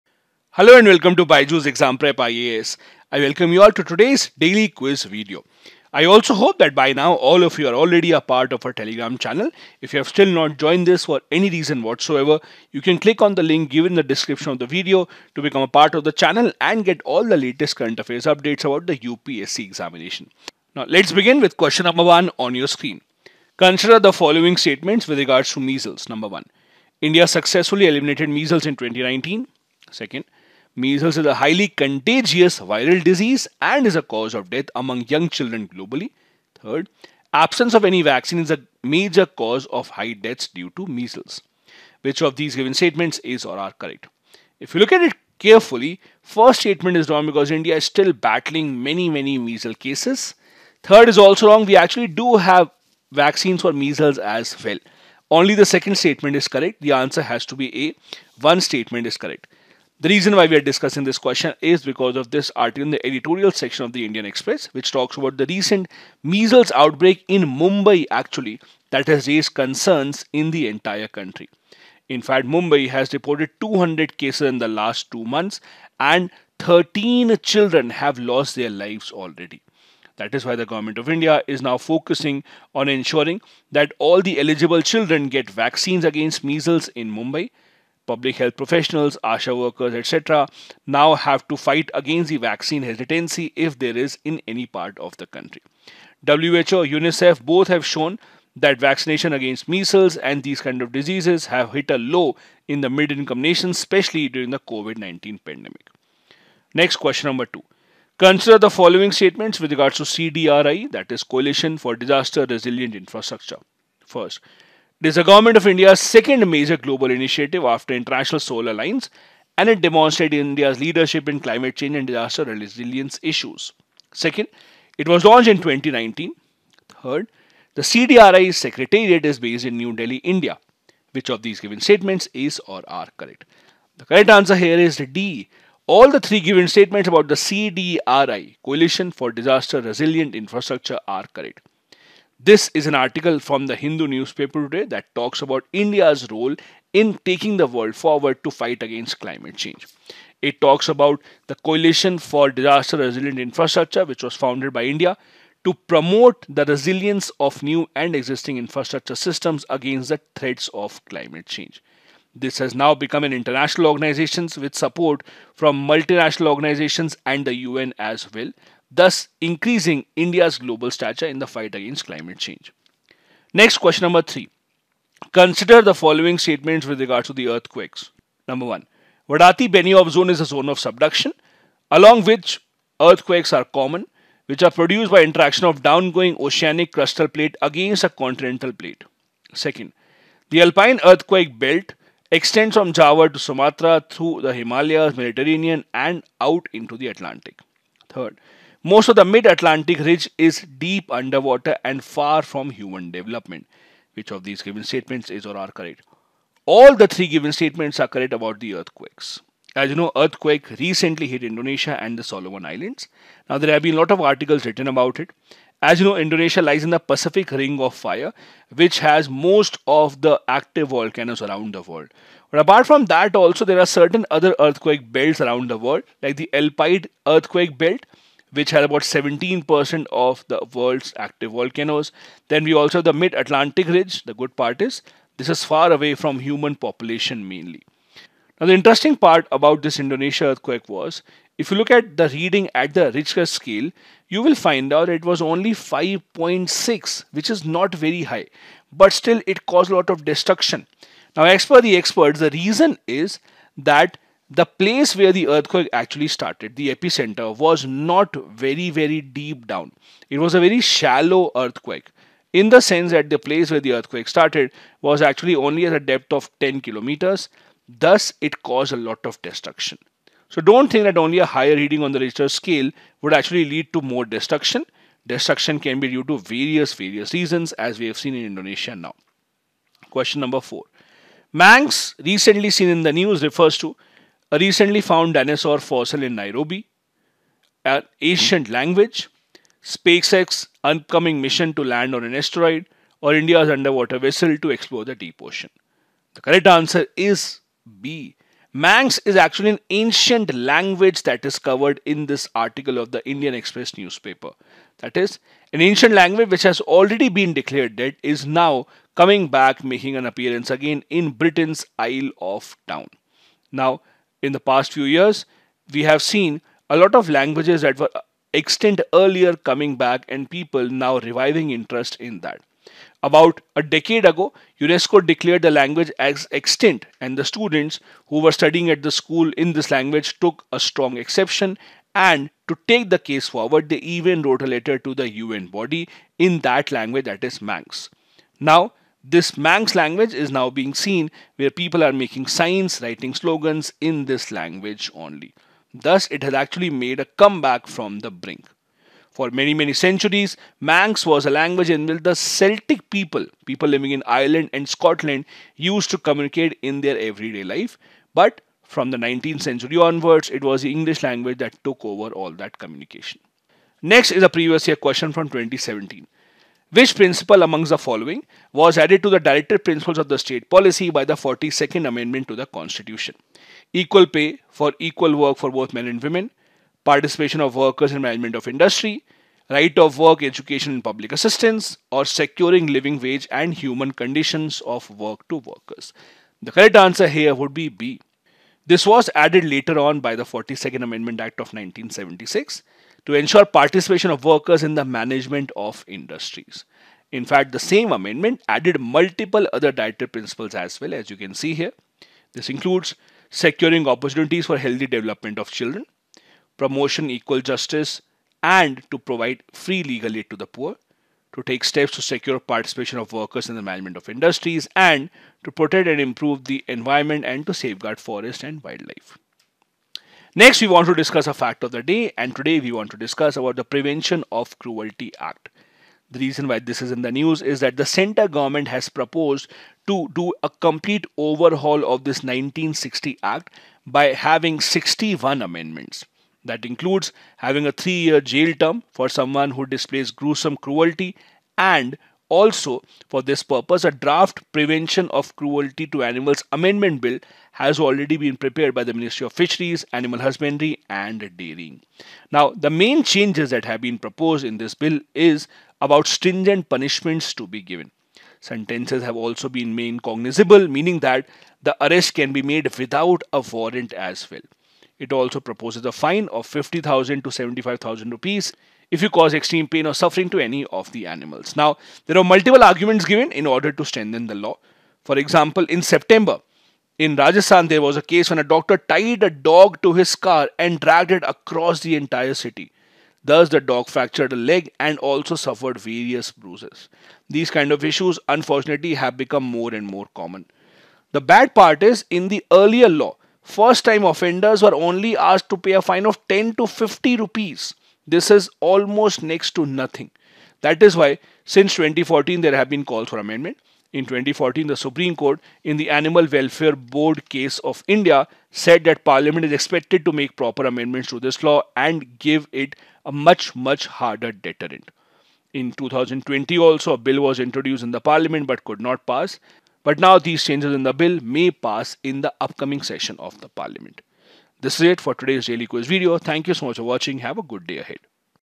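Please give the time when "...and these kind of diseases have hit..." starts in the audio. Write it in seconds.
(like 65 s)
100 s.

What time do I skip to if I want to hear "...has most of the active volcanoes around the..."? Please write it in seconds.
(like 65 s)
218 s.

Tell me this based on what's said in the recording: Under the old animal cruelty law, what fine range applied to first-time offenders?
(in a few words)
10 to 50 rupees.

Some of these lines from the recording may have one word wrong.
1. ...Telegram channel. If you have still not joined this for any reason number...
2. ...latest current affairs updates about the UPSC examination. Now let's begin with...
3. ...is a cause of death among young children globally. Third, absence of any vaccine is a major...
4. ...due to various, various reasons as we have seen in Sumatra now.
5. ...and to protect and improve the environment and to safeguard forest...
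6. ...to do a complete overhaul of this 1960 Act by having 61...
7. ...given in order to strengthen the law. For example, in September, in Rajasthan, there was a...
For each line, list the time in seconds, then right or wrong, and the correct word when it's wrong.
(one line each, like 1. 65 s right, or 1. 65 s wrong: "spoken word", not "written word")
1. 8 s wrong: "whatsoever", not "number"
2. 17 s right
3. 33 s right
4. 276 s wrong: "Indonesia", not "Sumatra"
5. 414 s right
6. 430 s right
7. 473 s right.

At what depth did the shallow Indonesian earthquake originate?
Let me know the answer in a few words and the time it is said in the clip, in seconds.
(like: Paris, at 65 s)
10 kilometers, at 266 s.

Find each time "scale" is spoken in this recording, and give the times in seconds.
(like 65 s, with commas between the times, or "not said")
243 s, 272 s.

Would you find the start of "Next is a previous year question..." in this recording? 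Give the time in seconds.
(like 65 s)
364 s.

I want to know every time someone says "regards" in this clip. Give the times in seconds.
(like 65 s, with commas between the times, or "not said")
25 s, 109 s, 176 s.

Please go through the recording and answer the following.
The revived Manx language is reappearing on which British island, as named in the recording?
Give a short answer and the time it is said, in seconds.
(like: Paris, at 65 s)
Isle of Town, at 311 s.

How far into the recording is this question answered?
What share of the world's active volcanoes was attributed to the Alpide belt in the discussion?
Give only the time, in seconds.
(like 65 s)
229 s.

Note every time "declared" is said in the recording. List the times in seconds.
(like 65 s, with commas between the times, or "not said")
307 s, 325 s.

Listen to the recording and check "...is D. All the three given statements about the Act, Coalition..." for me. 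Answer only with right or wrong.
wrong.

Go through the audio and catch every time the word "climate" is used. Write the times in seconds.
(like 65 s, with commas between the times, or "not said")
121 s, 149 s, 161 s, 172 s.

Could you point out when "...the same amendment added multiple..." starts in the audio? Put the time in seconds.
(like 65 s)
397 s.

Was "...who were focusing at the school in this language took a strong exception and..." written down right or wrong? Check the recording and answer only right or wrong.
wrong.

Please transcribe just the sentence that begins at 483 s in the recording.
Thus, the dog fractured a leg and also suffered various bruises.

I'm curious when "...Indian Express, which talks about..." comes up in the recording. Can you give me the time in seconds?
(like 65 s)
64 s.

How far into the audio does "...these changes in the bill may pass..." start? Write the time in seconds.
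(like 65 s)
520 s.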